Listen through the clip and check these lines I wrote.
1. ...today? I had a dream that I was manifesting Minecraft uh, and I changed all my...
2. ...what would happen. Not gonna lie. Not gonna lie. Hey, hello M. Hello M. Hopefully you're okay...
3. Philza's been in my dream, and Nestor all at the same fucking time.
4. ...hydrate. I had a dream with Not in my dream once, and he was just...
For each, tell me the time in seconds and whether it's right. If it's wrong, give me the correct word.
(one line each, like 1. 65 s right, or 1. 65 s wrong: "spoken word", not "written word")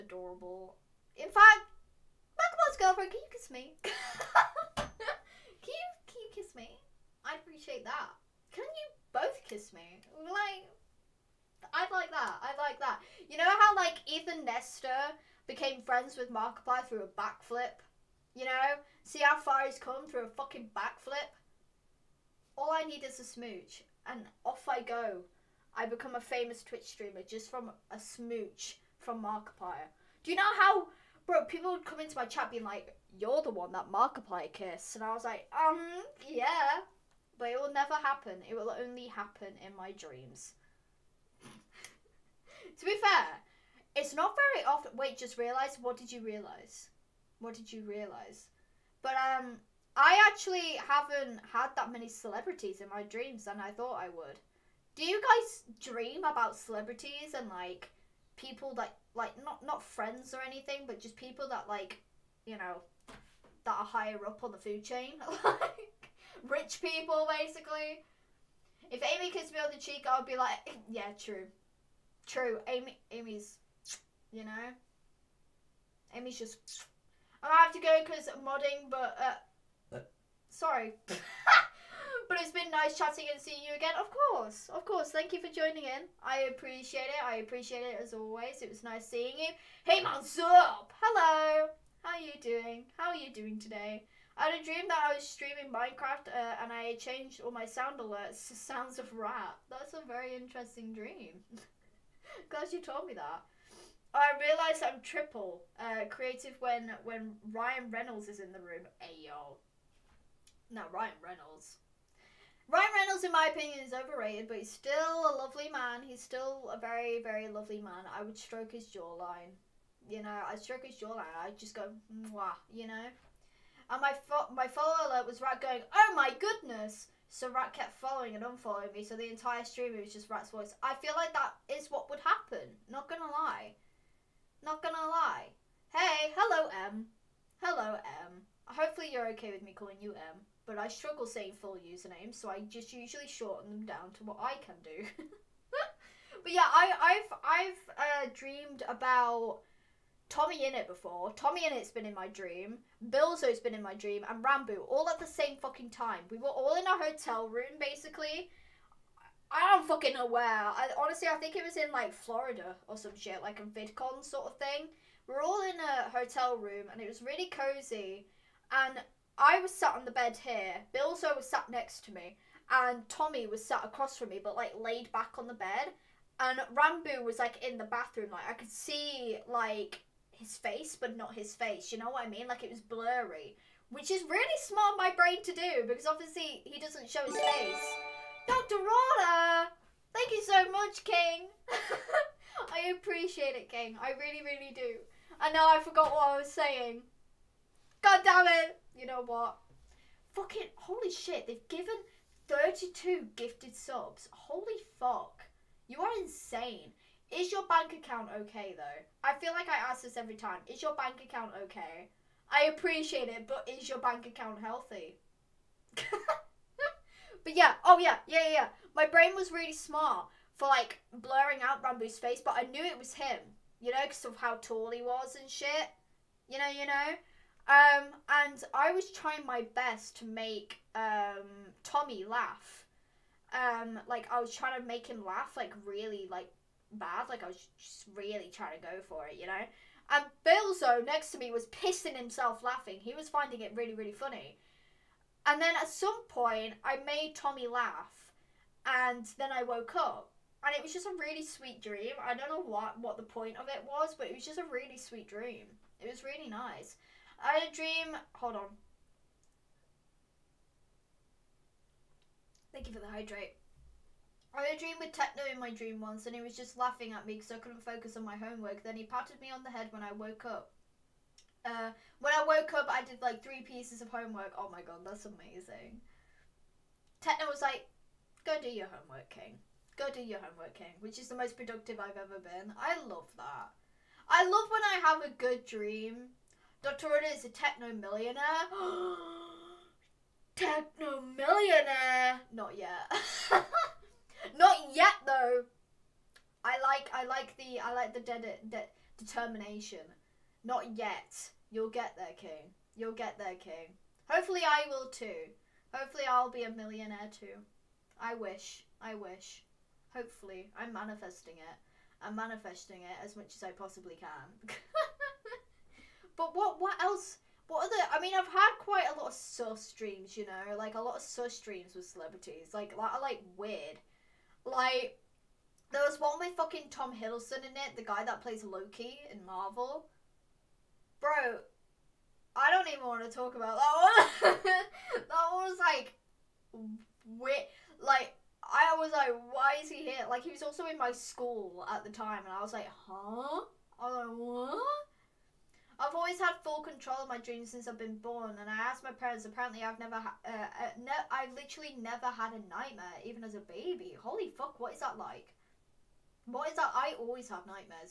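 1. 93 s wrong: "streaming", not "manifesting"
2. 131 s right
3. 153 s wrong: "Ranboo", not "Nestor"
4. 263 s wrong: "Techno", not "Not".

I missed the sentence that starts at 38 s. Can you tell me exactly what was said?
It will only happen in my dreams.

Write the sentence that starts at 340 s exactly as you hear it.
Like he was also in my school at the time, and I was like, huh?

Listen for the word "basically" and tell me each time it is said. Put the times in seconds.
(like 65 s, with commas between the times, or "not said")
67 s, 157 s.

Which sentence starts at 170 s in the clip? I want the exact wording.
Philza was sat next to me, and Tommy was sat across from me, but like laid back on the bed.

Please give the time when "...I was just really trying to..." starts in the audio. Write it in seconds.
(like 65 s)
237 s.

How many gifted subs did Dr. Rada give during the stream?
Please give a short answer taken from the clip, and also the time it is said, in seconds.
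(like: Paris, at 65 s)
32, at 202 s.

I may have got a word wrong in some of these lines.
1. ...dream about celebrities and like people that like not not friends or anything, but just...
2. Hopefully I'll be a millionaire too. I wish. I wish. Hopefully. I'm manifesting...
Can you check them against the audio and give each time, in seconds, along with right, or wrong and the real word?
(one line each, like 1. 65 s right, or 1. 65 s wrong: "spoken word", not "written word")
1. 55 s right
2. 305 s right.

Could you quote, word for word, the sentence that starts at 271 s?
Uh, when I woke up, I did like three pieces of homework.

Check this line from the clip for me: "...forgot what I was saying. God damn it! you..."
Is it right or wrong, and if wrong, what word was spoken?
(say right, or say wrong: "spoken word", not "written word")
right.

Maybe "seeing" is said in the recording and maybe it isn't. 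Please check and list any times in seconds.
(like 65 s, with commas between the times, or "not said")
83 s, 89 s.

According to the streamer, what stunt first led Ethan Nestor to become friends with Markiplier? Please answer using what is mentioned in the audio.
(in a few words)
A backflip.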